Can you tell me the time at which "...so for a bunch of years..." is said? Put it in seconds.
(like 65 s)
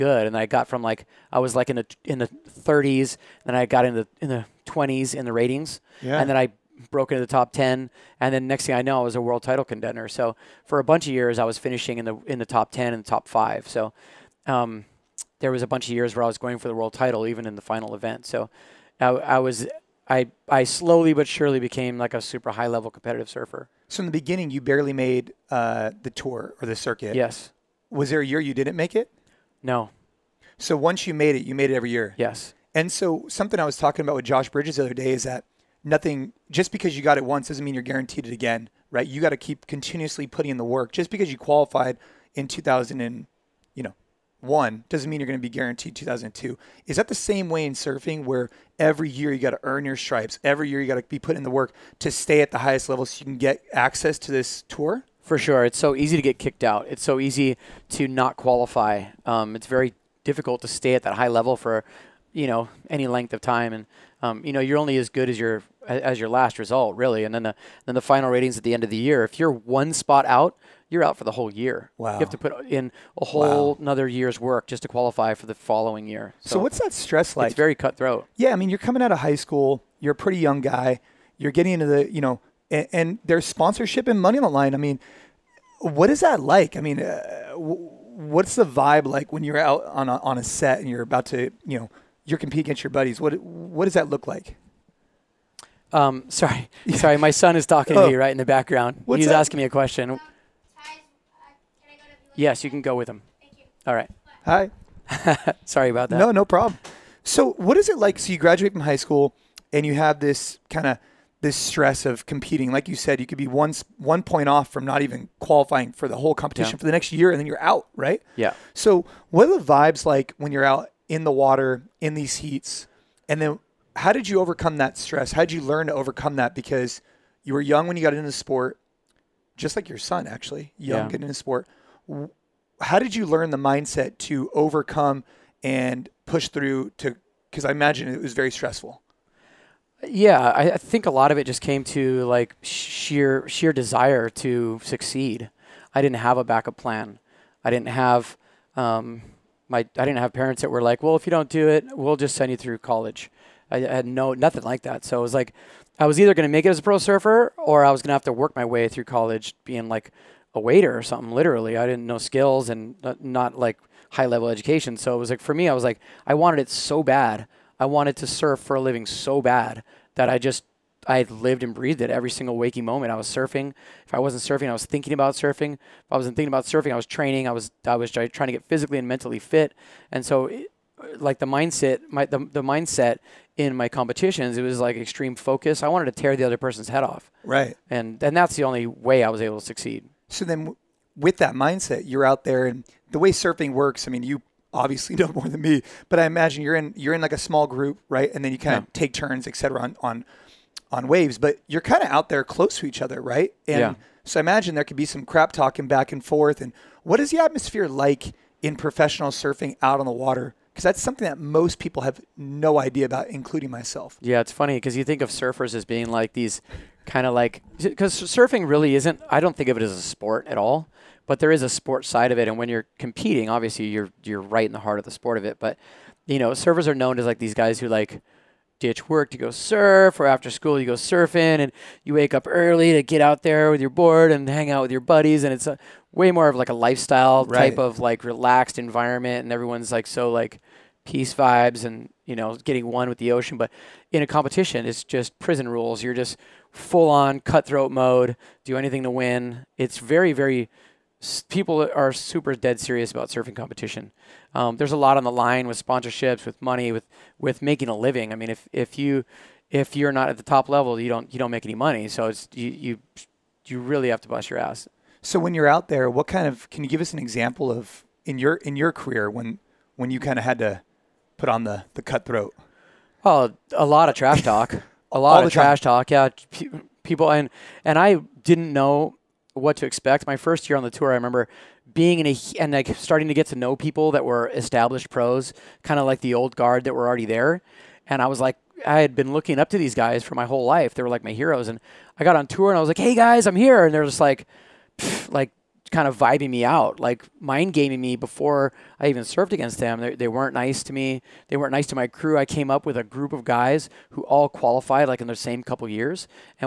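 10 s.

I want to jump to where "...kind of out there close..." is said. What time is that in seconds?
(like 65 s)
201 s.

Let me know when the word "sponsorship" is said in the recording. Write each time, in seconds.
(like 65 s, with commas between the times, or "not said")
83 s, 255 s.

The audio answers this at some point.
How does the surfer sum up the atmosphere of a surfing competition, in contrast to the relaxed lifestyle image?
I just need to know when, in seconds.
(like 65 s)
245 s.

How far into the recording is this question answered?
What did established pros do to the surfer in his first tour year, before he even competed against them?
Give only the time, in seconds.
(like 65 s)
297 s.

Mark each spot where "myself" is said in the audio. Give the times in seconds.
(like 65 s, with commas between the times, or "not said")
213 s.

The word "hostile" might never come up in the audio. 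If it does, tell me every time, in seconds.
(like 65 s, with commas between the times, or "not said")
not said.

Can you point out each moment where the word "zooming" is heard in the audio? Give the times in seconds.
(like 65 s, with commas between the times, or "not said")
not said.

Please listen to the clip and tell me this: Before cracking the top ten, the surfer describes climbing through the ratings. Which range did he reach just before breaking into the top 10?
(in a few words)
the 20s.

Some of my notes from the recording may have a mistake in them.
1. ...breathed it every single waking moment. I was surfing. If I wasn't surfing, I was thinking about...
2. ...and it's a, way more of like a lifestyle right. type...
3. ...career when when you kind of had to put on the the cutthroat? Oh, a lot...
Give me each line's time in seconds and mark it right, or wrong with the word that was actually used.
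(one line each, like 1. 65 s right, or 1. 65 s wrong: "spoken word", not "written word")
1. 171 s right
2. 235 s right
3. 268 s right.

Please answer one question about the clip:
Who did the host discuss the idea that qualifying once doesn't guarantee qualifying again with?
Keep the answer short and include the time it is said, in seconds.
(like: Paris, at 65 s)
Josh Bridges, at 34 s.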